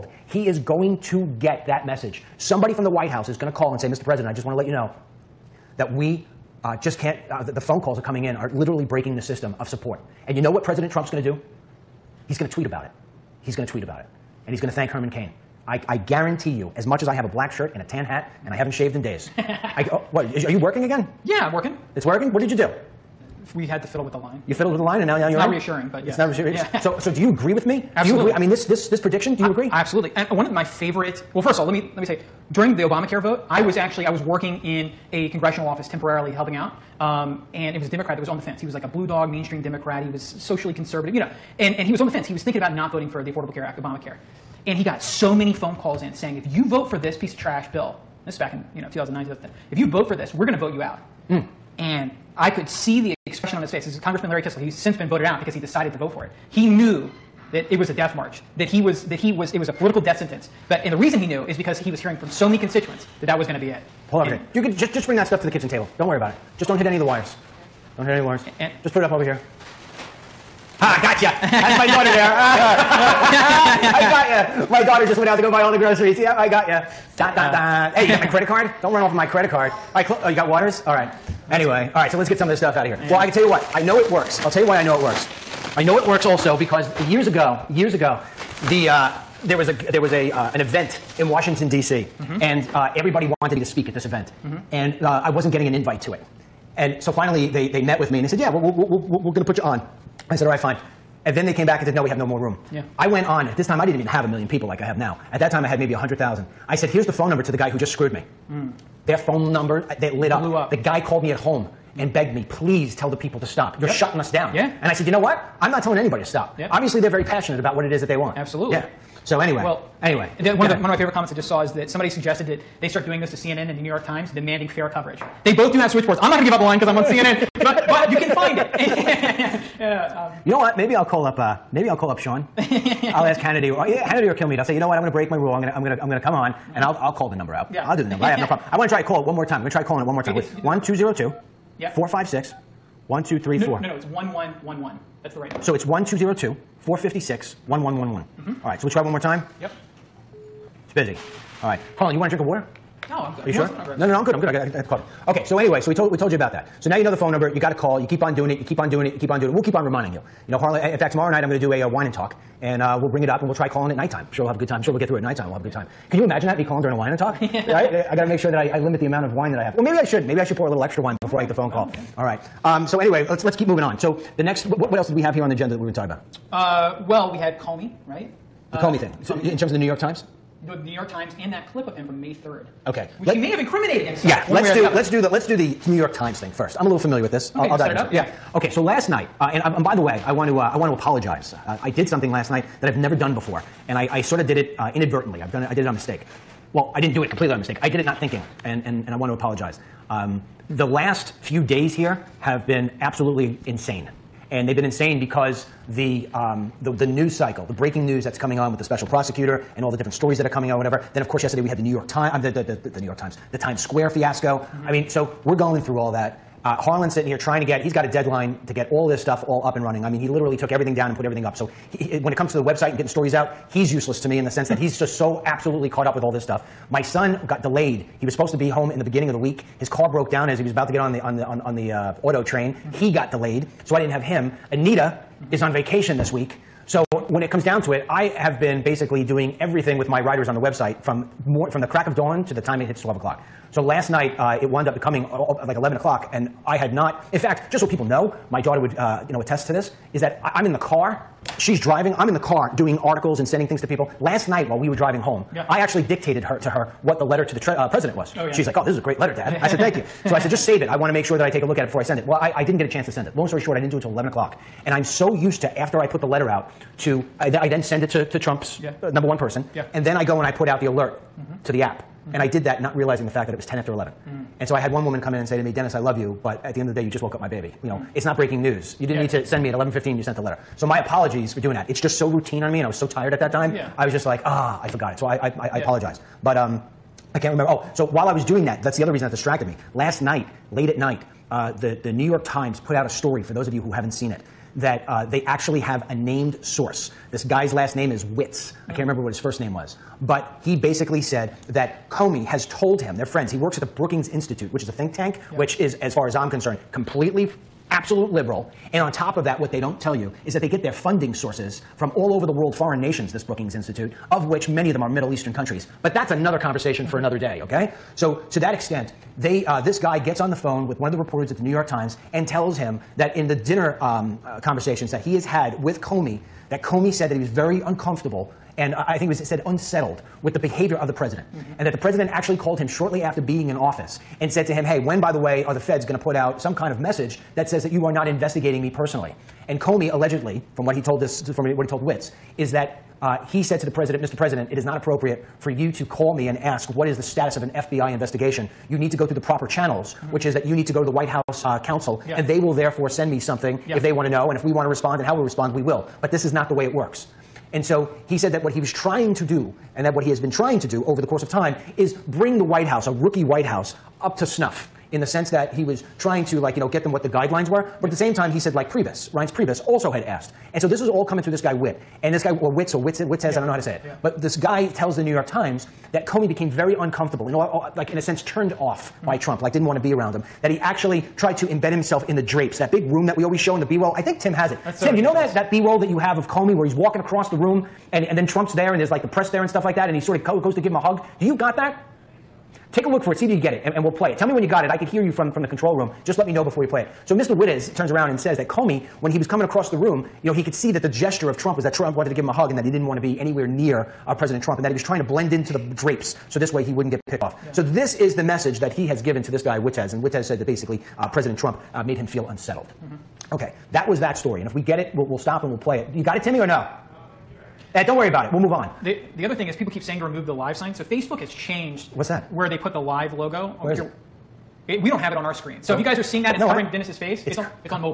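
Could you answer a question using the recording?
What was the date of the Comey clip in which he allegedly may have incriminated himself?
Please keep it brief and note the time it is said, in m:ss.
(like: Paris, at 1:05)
May 3rd, at 3:02.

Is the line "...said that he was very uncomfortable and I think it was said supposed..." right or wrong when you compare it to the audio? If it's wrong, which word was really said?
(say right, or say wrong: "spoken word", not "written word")
wrong: "unsettled", not "supposed".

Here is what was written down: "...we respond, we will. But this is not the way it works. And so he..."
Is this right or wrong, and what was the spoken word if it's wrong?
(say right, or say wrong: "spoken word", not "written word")
right.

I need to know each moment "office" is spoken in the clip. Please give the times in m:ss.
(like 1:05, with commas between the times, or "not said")
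0:35, 5:33.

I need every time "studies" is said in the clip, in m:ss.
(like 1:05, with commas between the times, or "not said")
not said.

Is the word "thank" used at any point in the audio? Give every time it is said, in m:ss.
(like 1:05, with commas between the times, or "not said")
0:14, 4:19.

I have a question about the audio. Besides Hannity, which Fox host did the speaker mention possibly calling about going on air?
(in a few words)
Kilmeade.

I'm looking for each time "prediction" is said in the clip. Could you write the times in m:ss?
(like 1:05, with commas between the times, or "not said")
0:28.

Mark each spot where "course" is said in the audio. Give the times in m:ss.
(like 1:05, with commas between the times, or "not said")
3:31, 6:01.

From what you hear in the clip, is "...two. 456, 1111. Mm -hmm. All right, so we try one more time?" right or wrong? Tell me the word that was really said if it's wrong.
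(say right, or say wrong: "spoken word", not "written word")
right.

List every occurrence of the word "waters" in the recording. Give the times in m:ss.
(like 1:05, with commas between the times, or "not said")
1:20, 2:32.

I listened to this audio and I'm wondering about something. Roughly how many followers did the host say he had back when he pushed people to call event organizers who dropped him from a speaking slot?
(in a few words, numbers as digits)
100,000.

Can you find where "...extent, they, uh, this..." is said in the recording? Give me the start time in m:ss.
5:18.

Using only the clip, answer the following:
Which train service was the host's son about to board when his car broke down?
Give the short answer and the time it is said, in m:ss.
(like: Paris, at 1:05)
auto train, at 3:52.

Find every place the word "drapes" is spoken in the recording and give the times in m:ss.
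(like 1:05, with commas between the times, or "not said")
6:22, 6:45.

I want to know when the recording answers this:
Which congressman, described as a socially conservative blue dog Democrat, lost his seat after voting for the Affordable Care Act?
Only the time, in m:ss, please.
0:54.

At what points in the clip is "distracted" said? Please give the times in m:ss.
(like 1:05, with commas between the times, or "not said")
4:49.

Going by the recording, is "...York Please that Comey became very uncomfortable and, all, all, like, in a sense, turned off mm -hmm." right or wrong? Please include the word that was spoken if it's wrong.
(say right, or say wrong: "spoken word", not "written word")
wrong: "Times", not "Please".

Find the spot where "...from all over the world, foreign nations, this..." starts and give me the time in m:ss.
5:11.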